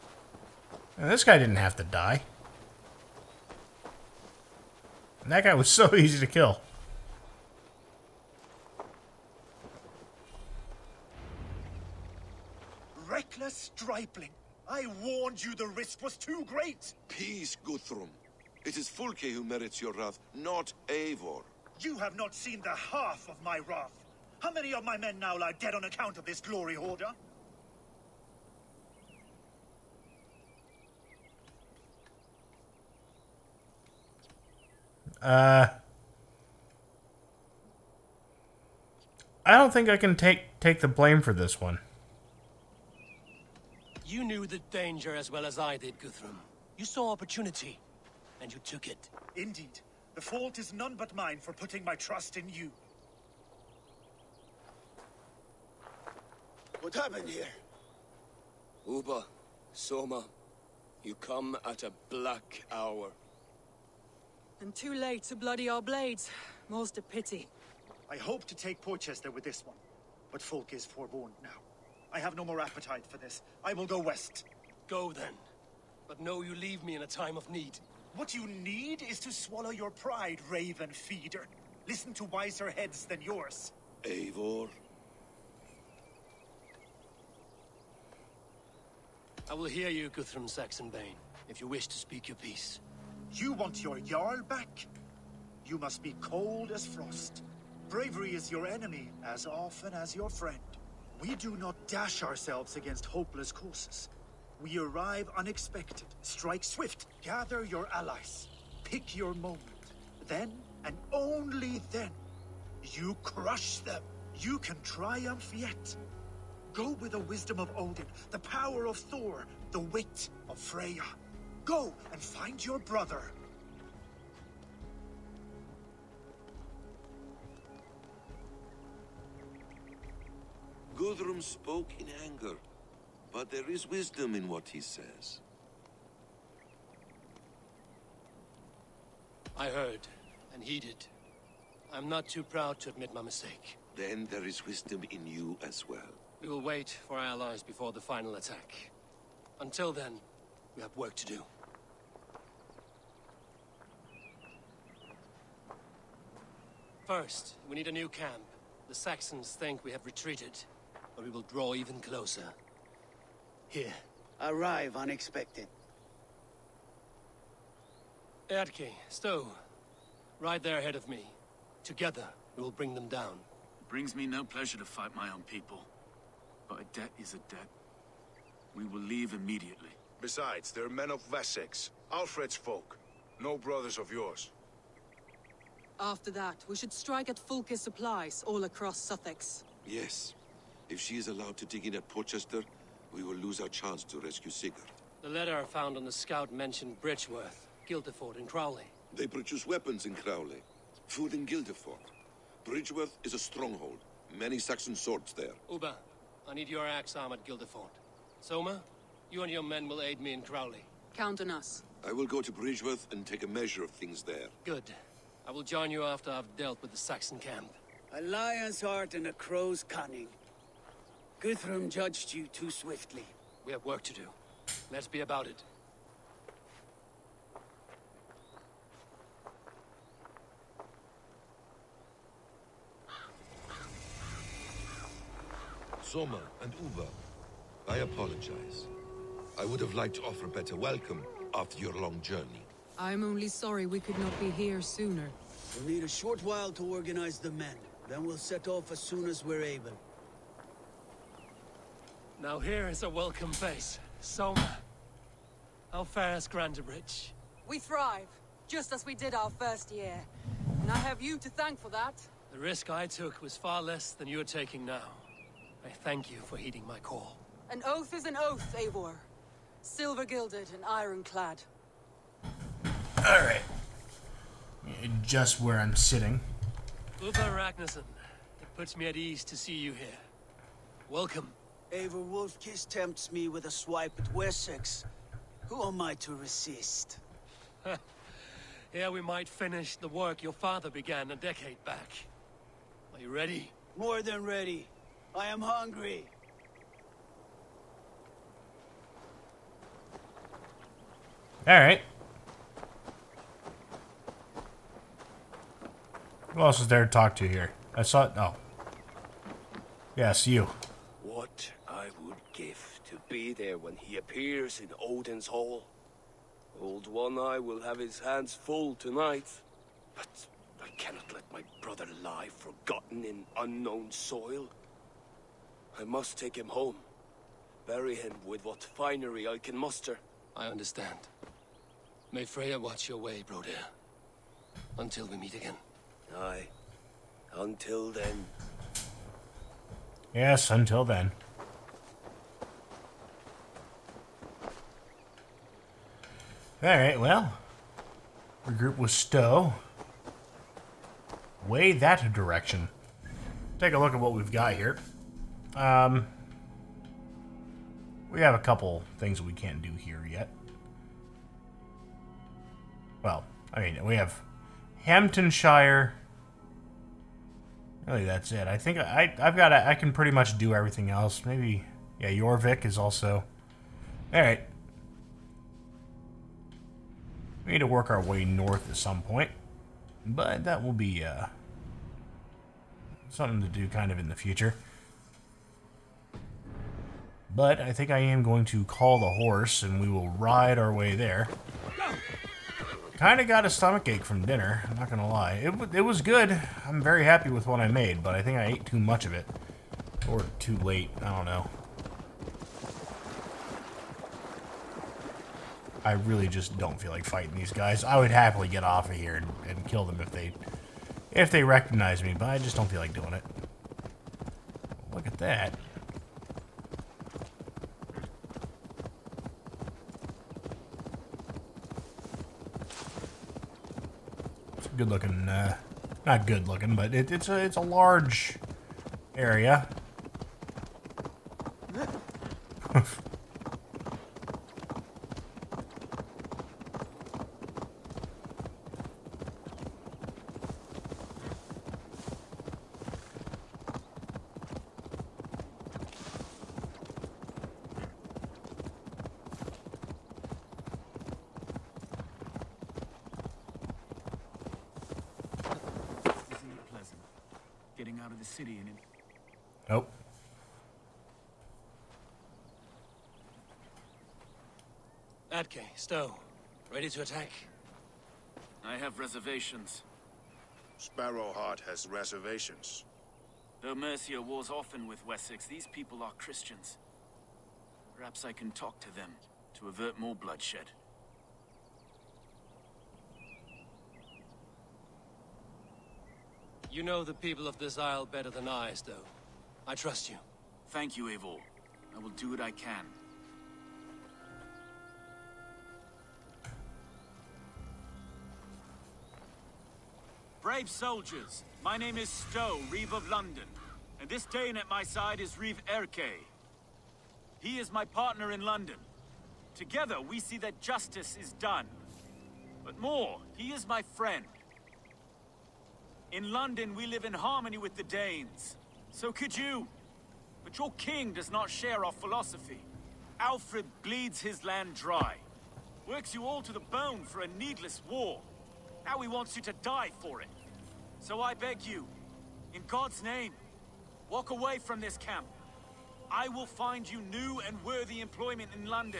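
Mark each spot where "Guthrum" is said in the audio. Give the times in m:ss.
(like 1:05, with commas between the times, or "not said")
0:17, 0:45, 1:30, 2:11, 3:41.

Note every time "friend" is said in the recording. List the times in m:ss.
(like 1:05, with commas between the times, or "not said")
1:40, 8:34.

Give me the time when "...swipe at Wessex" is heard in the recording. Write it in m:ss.
4:43.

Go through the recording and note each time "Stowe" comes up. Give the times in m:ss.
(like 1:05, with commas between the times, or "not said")
2:49, 5:49, 7:45, 8:08, 8:22.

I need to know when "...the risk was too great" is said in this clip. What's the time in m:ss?
0:15.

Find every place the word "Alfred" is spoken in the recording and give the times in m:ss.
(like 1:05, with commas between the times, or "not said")
3:02, 8:43.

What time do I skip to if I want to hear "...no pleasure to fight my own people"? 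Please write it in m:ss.
2:54.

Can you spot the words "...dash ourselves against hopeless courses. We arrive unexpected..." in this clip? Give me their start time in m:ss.
1:41.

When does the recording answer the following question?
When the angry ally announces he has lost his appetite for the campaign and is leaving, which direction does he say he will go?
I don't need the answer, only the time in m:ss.
1:13.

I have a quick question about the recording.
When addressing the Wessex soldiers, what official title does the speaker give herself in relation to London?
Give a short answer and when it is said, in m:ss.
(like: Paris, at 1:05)
Reeve of London, at 8:22.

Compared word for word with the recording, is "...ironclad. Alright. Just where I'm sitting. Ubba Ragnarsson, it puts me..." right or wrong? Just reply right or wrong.
right.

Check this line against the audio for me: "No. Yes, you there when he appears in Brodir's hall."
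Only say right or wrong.
wrong.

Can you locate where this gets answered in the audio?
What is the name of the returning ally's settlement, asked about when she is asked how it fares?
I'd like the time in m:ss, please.
4:15.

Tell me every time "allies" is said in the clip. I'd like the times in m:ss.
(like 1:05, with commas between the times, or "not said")
1:47, 2:27.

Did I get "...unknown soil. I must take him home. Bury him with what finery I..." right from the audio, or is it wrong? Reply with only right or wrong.
right.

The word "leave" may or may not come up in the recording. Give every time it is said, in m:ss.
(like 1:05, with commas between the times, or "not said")
1:16, 2:59.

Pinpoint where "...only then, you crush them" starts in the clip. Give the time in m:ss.
1:51.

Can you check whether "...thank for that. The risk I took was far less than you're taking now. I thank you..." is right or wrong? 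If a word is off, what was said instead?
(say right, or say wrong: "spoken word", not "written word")
right.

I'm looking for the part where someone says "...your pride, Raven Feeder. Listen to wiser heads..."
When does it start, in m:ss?
1:19.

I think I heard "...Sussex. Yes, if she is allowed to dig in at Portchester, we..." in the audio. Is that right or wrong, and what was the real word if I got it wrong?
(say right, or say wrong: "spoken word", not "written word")
right.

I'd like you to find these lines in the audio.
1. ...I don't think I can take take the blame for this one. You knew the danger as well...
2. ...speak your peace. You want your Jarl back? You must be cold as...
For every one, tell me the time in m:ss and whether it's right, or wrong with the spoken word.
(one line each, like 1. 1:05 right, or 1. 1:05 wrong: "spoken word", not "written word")
1. 0:39 right
2. 1:31 right.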